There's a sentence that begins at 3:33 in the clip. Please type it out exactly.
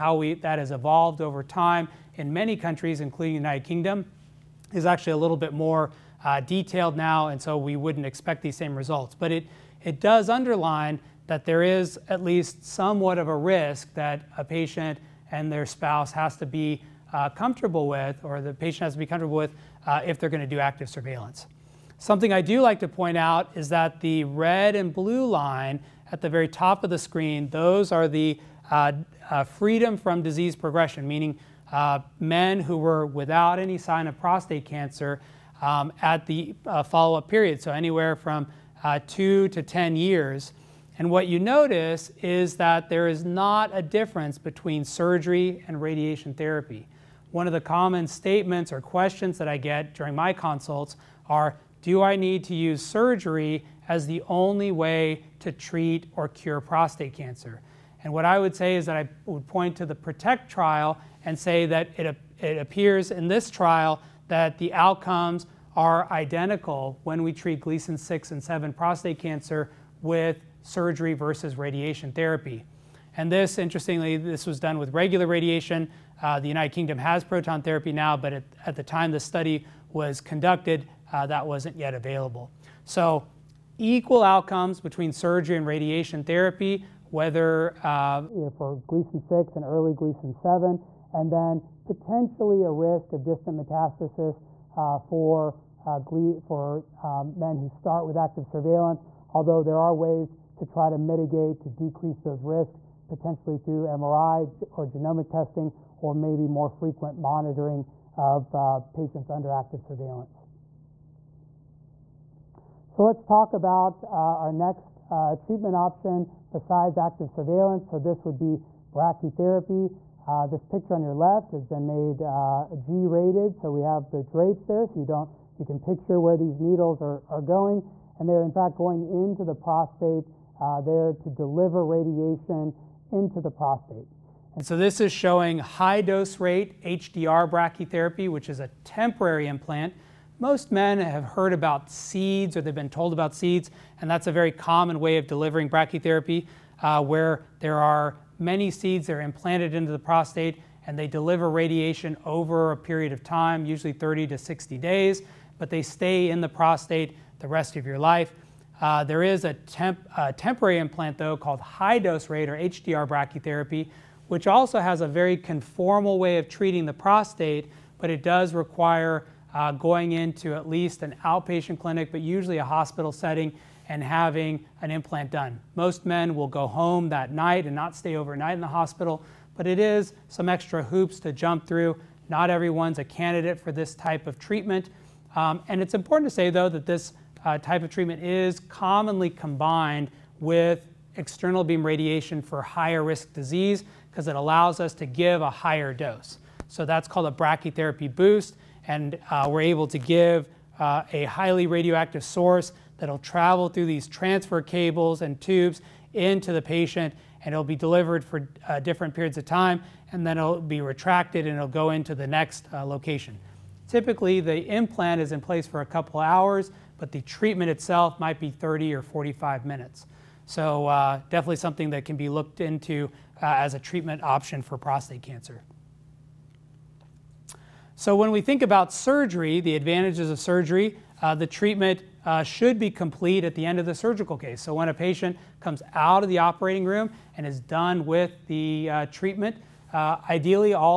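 Typically the implant is in place for a couple hours but the treatment itself might be 30 or 45 minutes.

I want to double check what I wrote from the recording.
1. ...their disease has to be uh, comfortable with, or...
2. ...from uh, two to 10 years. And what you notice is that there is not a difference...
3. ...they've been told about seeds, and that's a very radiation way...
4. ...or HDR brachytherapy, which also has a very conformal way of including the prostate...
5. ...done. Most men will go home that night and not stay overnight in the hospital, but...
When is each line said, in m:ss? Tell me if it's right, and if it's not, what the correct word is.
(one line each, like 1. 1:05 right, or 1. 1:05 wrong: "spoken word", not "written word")
1. 0:15 wrong: "spouse", not "disease"
2. 0:38 right
3. 2:22 wrong: "common", not "radiation"
4. 2:42 wrong: "treating", not "including"
5. 2:55 right.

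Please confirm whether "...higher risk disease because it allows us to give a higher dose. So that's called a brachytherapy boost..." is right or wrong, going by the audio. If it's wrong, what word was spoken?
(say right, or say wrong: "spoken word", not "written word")
right.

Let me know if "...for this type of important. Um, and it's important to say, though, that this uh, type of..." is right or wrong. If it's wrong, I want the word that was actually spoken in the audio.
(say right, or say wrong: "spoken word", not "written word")
wrong: "treatment", not "important".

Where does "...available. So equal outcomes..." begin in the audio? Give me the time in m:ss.
1:21.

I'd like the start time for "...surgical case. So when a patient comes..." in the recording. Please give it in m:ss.
3:53.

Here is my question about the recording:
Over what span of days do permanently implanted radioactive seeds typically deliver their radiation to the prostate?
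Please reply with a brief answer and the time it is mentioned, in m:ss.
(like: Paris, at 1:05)
30 to 60 days, at 2:33.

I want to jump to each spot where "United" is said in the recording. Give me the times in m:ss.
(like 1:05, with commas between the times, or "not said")
0:03, 1:16.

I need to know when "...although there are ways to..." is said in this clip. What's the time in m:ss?
1:39.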